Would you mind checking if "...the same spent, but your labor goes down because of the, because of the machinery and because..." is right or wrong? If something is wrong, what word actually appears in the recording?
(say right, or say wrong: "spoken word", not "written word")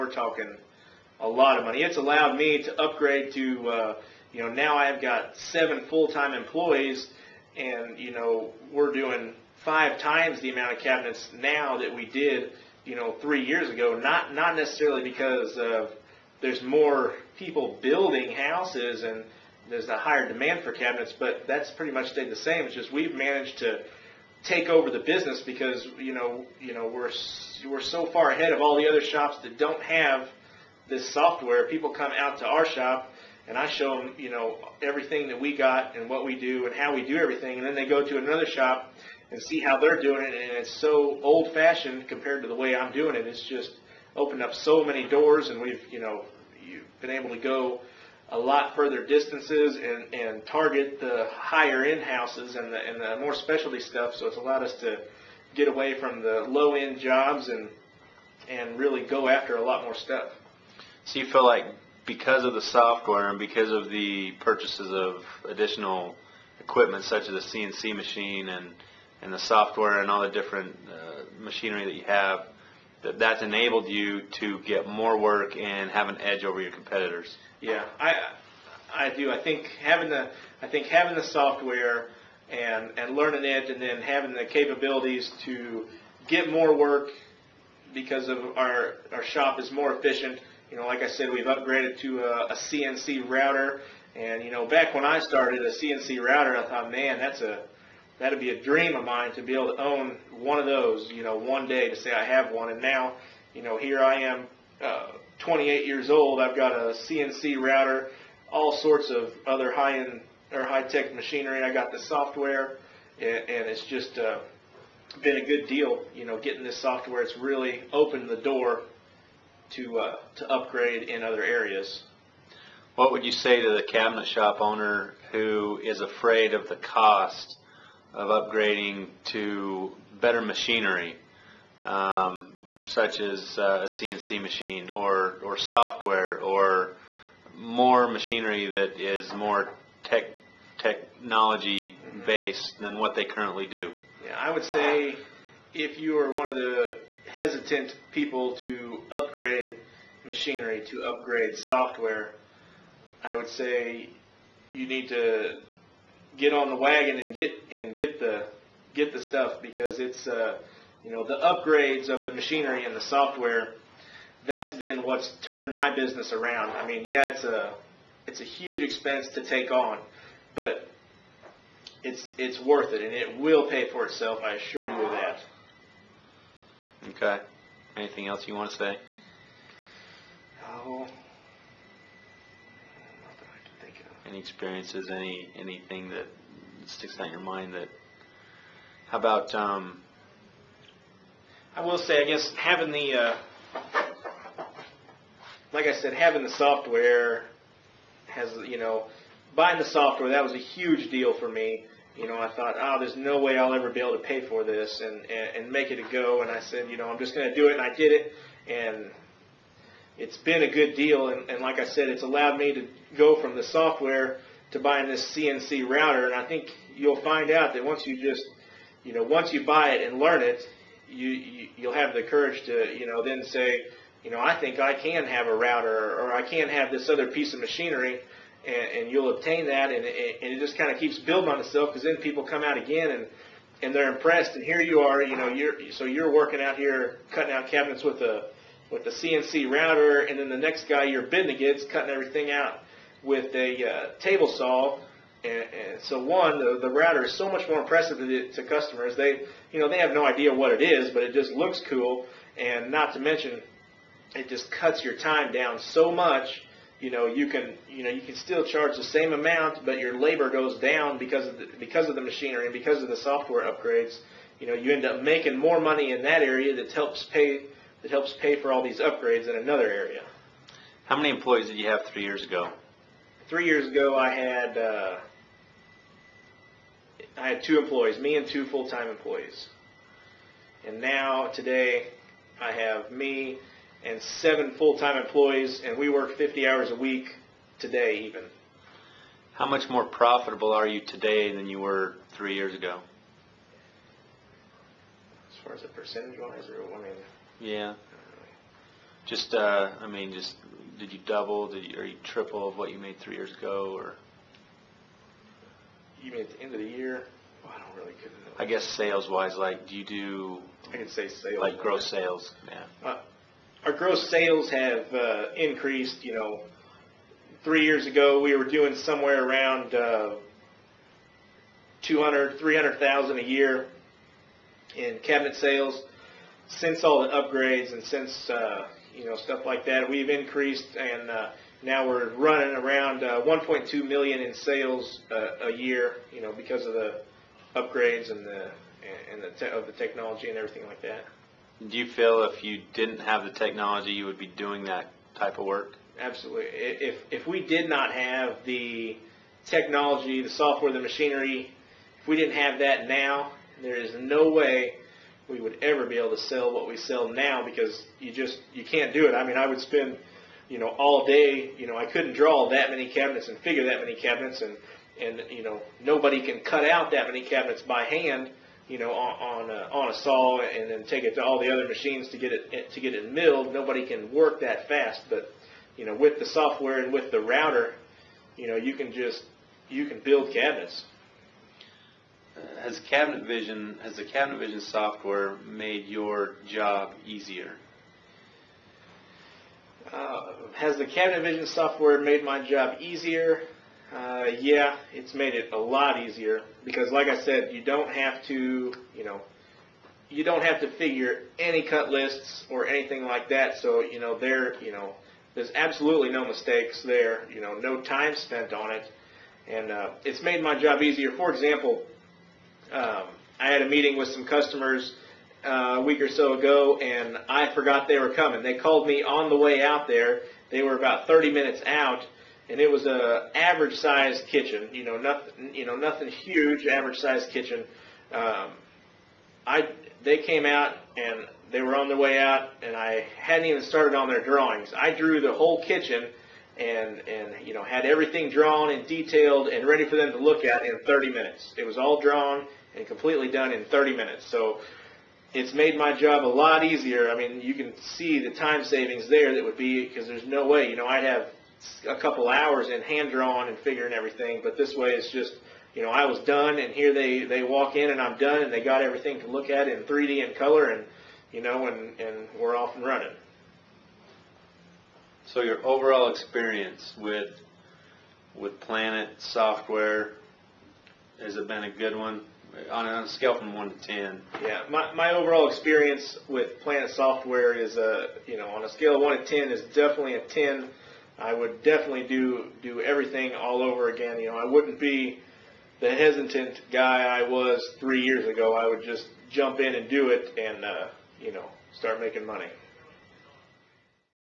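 wrong: "amount", not "spent".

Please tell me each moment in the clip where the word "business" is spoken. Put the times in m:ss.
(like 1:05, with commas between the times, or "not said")
0:24, 2:45.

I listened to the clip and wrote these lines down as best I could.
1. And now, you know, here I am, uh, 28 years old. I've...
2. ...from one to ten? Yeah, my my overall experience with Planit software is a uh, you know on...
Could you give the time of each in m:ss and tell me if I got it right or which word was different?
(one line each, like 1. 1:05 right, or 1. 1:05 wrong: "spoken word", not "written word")
1. 1:42 right
2. 7:53 right.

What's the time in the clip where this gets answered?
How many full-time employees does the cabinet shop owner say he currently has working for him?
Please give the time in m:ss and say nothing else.
0:05.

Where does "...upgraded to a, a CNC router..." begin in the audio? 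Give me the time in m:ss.
1:31.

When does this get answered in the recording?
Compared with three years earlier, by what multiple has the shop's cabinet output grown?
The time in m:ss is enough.
0:09.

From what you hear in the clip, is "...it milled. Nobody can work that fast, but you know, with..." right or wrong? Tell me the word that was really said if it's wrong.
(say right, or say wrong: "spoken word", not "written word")
right.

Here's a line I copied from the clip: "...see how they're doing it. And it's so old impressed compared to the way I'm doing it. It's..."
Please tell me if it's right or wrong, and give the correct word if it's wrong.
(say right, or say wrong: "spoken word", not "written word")
wrong: "fashioned", not "impressed".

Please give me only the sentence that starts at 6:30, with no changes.
Uh, has the Cabinet Vision software made my job easier?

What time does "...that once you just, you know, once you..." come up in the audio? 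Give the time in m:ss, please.
3:37.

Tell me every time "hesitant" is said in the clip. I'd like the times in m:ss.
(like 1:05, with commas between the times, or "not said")
2:27, 8:06.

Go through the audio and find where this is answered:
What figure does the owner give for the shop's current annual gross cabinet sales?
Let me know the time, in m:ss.
5:33.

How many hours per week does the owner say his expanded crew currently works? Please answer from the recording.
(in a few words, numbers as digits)
50.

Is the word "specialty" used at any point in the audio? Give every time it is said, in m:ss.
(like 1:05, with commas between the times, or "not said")
0:53.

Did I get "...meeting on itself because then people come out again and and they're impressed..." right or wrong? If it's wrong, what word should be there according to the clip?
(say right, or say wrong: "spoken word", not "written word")
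wrong: "building", not "meeting".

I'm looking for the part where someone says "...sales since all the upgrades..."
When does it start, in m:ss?
5:25.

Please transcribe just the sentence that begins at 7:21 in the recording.
It was all drawn and completely done in 30 minutes.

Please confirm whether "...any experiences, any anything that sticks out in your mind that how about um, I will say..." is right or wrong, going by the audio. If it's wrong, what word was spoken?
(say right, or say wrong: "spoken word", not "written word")
right.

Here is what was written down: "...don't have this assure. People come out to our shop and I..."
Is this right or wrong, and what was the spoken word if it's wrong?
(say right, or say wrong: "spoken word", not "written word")
wrong: "software", not "assure".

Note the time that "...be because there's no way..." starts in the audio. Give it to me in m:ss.
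7:29.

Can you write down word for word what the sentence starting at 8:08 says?
I would just jump in and do it, and uh, you know, start making money.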